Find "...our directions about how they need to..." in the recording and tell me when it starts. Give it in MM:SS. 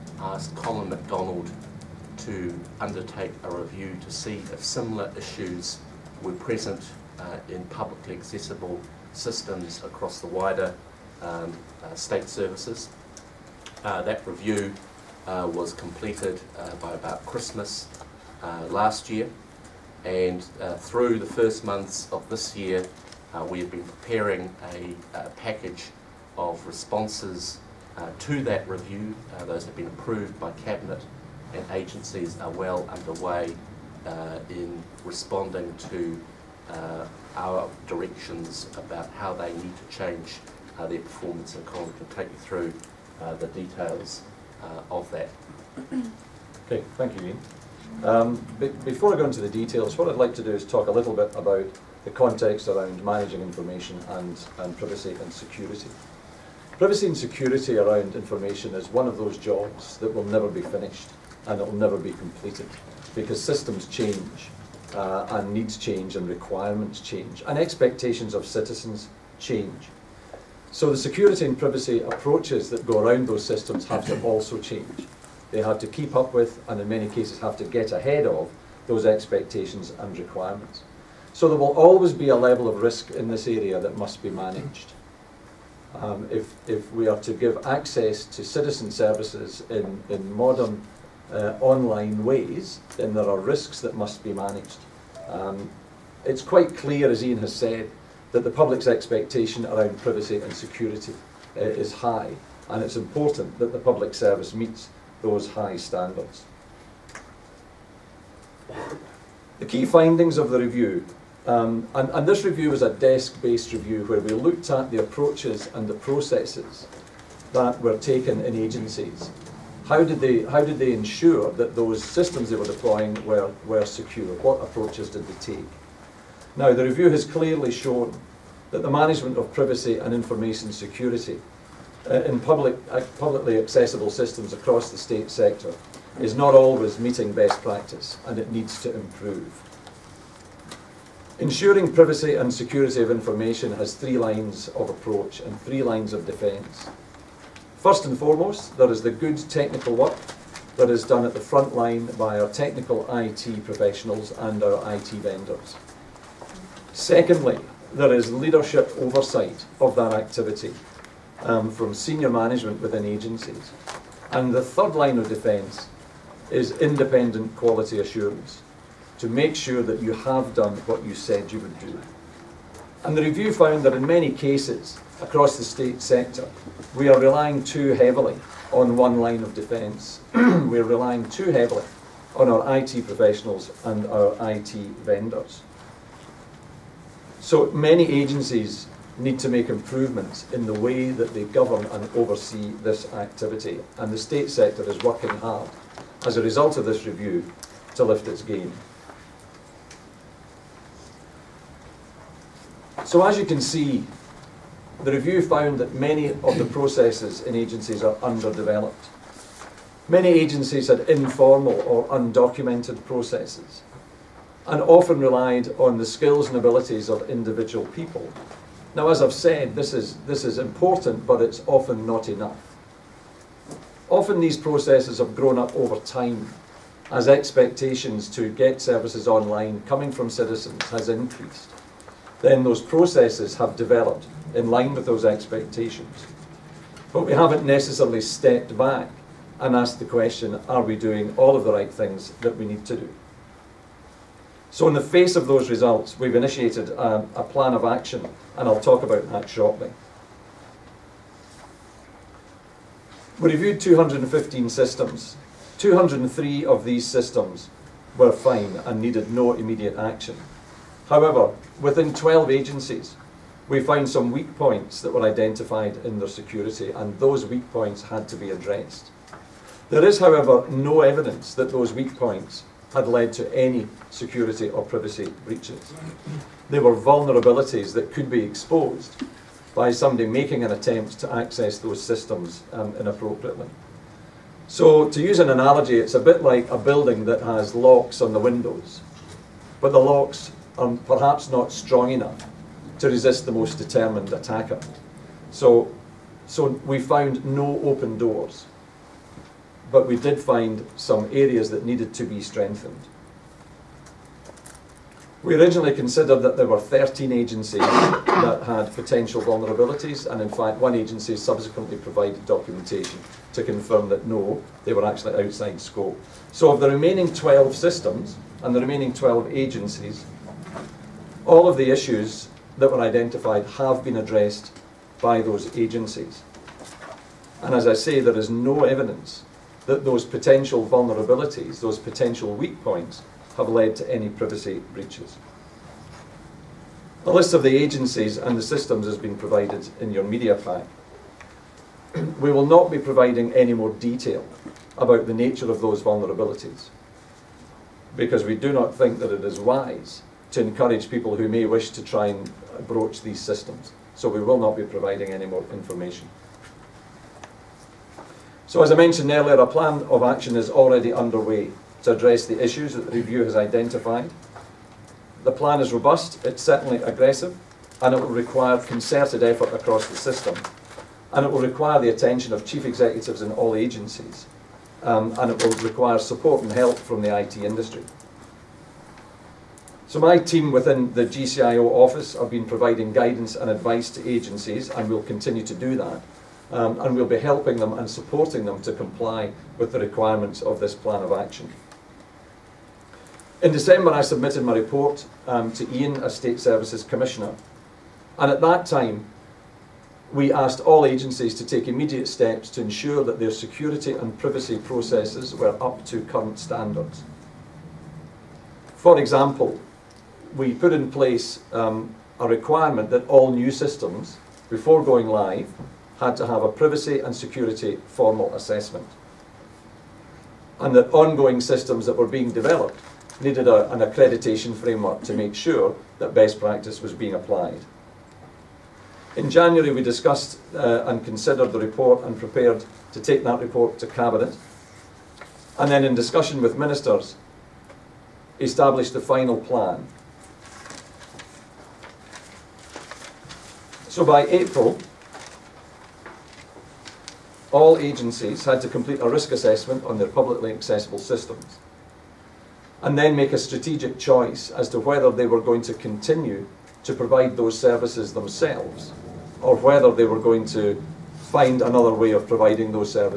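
00:37.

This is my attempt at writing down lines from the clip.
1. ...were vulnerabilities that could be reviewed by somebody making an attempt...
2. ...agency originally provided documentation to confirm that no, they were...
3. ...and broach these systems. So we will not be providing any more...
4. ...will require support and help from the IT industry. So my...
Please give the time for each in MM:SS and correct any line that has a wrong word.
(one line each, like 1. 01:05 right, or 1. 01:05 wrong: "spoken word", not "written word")
1. 04:36 wrong: "exposed", not "reviewed"
2. 05:10 wrong: "subsequently", not "originally"
3. 05:52 right
4. 06:15 right.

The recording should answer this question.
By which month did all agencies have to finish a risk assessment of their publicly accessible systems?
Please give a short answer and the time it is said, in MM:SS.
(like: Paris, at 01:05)
April, at 07:24.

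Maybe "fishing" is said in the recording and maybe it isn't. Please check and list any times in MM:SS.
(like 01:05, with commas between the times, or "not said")
not said.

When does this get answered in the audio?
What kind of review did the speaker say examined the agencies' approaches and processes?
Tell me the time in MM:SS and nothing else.
01:52.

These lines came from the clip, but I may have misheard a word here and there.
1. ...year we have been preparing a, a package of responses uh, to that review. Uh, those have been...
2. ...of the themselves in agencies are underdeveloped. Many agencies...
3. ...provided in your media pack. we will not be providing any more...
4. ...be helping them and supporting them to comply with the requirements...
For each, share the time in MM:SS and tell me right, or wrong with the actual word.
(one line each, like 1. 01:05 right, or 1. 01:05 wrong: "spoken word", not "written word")
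1. 00:22 right
2. 03:26 wrong: "processes", not "themselves"
3. 05:39 right
4. 06:27 right.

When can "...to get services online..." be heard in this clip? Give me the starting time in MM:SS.
03:48.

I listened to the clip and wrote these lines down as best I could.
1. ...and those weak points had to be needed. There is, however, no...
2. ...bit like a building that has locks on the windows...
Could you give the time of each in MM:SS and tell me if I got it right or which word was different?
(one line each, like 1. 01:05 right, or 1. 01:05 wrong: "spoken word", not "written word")
1. 04:26 wrong: "addressed", not "needed"
2. 04:46 right.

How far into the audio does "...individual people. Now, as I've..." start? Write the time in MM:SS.
03:37.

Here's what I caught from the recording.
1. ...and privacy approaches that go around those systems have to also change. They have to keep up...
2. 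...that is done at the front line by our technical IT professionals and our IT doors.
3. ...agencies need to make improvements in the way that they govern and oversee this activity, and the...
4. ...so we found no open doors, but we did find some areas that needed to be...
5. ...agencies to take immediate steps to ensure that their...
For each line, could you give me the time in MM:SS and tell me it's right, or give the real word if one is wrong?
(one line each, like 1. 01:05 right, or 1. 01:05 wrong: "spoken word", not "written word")
1. 01:11 right
2. 02:30 wrong: "vendors", not "doors"
3. 03:08 right
4. 04:56 right
5. 06:41 right.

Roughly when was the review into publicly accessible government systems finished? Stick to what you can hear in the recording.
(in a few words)
Christmas last year.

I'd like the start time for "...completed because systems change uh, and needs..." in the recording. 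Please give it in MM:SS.
01:02.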